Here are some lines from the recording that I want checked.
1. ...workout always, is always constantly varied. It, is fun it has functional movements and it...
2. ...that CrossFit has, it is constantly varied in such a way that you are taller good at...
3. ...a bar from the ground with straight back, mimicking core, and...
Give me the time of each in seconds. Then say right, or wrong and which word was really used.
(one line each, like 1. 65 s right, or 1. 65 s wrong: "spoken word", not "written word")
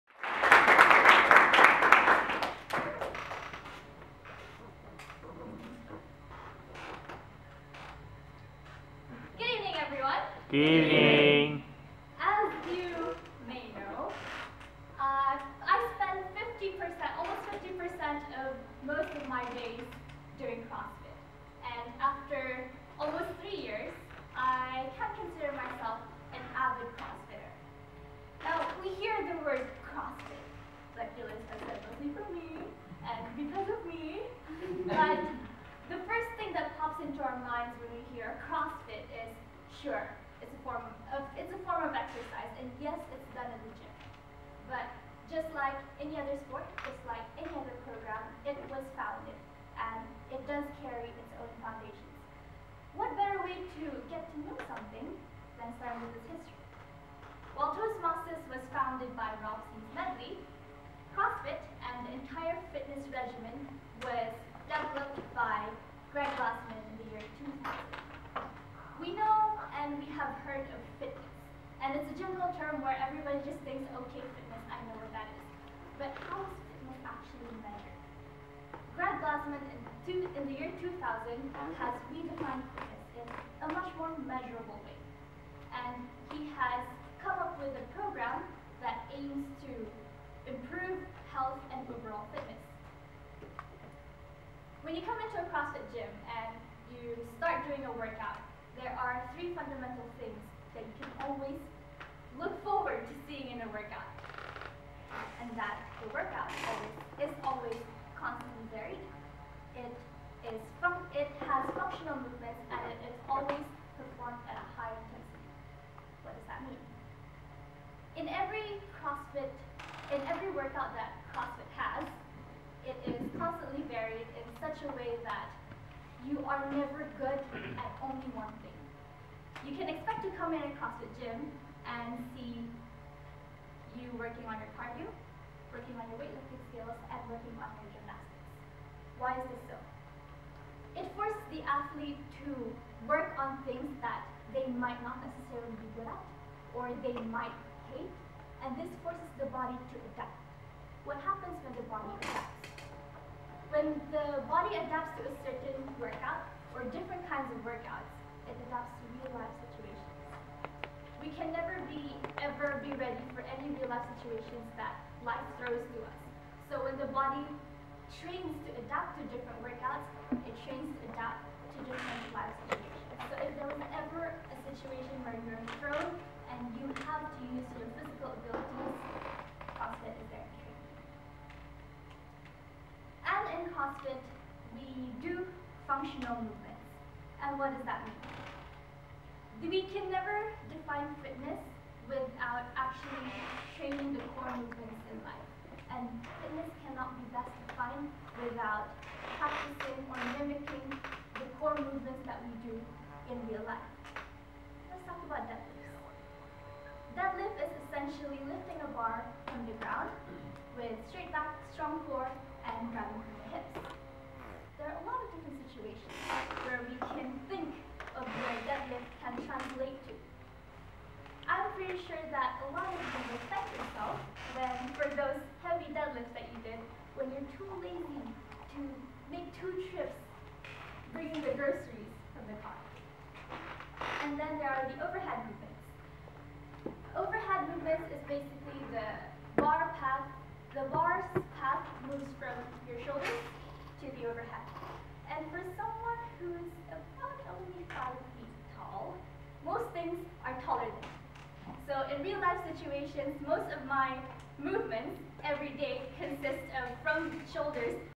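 1. 106 s right
2. 120 s wrong: "never", not "taller"
3. 208 s wrong: "strong", not "mimicking".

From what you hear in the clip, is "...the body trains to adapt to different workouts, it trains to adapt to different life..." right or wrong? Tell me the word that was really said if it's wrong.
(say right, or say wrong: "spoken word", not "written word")
right.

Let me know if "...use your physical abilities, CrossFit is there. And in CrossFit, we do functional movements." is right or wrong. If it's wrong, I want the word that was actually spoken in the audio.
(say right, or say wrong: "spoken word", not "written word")
right.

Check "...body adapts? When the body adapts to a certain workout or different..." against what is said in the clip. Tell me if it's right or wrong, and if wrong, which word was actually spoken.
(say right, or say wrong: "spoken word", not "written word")
right.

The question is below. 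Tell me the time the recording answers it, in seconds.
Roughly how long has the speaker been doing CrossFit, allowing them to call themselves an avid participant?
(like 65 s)
22 s.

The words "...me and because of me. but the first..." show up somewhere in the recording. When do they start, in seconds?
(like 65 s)
32 s.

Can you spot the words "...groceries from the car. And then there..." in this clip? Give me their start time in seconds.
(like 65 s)
231 s.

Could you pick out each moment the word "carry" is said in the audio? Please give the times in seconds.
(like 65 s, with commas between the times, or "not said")
50 s.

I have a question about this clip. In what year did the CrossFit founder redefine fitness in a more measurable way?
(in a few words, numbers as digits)
2000.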